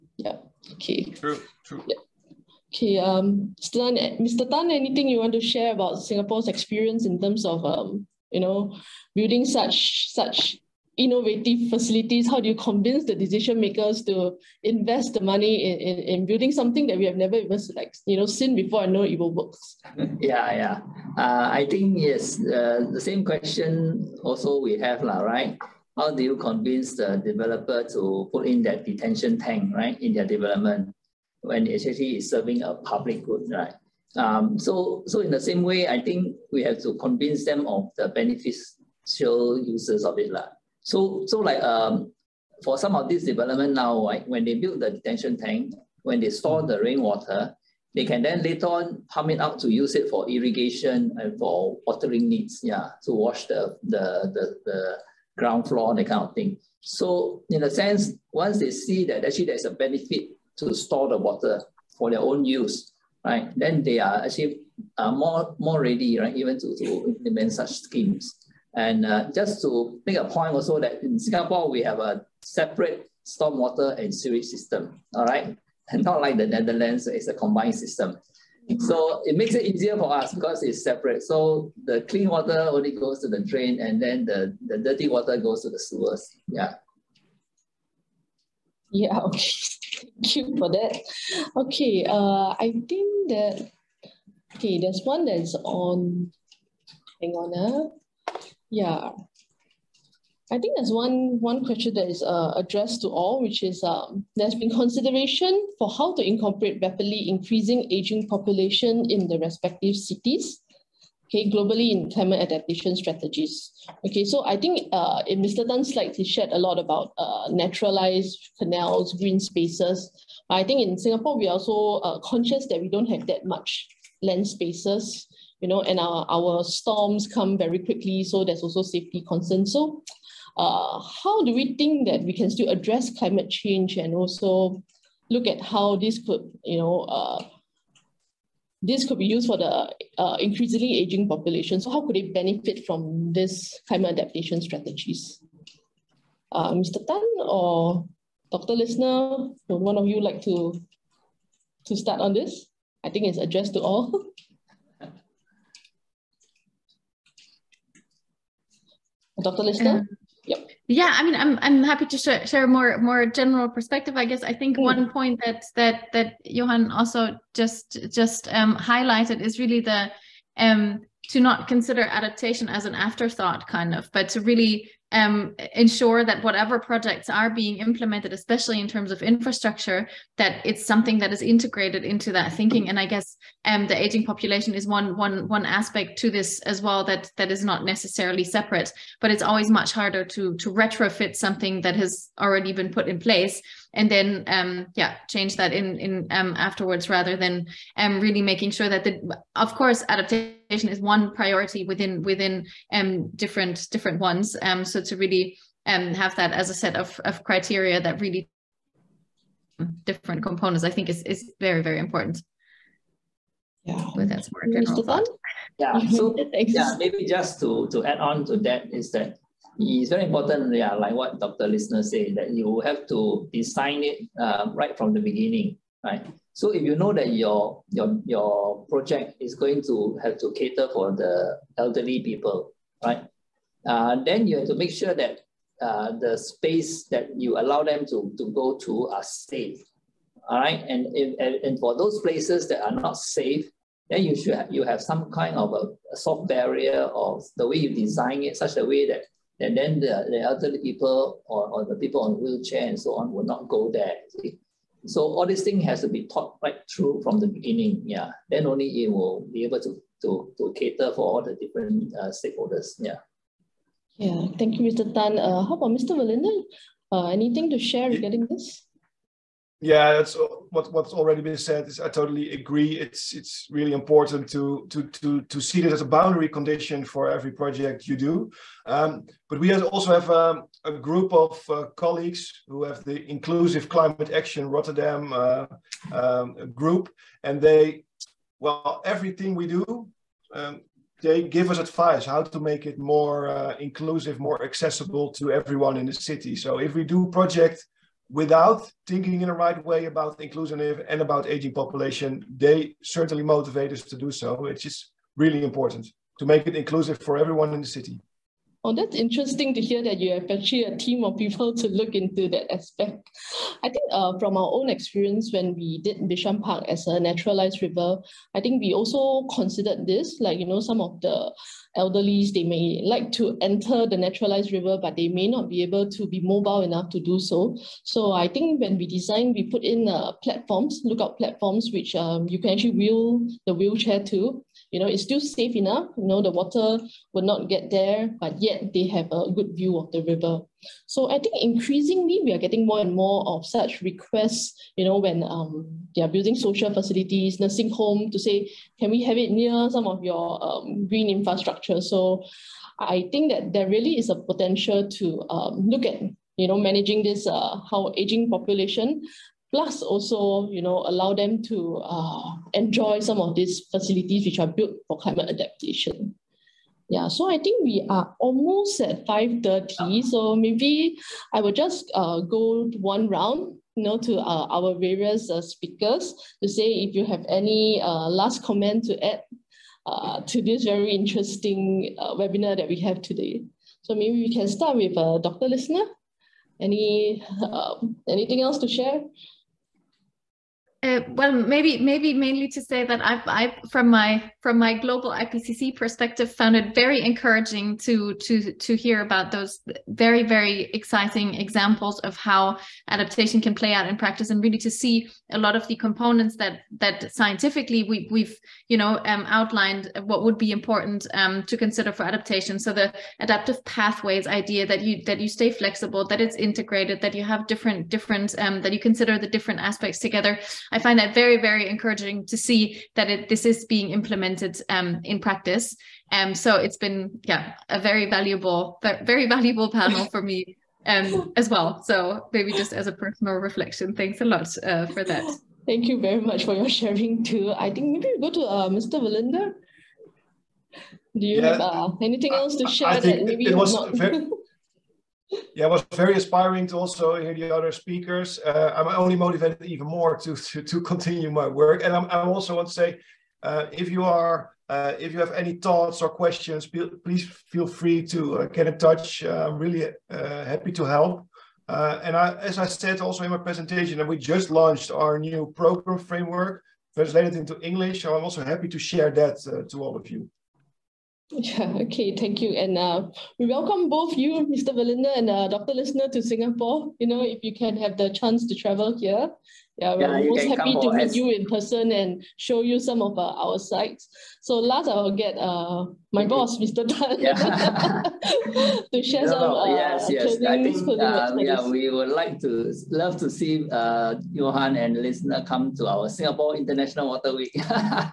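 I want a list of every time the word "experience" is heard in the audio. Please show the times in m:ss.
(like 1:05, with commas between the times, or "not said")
0:06, 5:14.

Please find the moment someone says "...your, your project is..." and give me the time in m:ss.
3:47.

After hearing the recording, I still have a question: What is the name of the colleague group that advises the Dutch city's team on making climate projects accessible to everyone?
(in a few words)
Inclusive Climate Action Rotterdam.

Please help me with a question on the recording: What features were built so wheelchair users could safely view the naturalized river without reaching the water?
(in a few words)
lookout platforms.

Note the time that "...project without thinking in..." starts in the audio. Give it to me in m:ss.
4:57.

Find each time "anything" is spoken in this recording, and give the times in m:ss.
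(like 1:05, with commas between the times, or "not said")
0:04, 4:27, 6:28, 7:22.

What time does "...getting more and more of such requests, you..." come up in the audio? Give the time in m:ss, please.
5:42.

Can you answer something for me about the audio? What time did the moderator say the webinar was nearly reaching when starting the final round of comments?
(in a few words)
5:30.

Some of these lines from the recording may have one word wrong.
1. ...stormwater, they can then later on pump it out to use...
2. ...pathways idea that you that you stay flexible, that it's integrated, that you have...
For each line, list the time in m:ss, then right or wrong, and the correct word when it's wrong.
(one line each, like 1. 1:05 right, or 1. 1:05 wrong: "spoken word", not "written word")
1. 0:46 wrong: "rainwater", not "stormwater"
2. 6:53 right.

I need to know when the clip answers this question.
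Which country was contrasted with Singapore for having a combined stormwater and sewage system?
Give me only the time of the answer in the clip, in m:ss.
1:16.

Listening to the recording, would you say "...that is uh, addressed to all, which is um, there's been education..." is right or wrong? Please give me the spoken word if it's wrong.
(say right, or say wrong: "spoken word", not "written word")
wrong: "consideration", not "education".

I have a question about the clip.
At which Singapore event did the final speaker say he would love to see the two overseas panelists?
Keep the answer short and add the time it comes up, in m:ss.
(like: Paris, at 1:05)
Singapore International Water Week, at 8:16.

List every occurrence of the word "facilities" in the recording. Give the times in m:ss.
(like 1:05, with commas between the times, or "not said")
0:11, 5:46, 6:03.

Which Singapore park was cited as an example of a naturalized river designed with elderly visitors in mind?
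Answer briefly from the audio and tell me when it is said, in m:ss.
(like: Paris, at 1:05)
Bishan Park, at 5:16.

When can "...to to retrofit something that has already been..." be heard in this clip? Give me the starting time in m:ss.
3:10.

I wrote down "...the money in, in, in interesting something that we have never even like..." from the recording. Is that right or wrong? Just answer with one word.
wrong.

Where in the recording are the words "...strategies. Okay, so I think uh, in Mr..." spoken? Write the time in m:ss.
1:52.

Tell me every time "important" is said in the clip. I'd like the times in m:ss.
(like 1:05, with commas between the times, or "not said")
3:31, 3:40, 4:33, 5:05, 6:50.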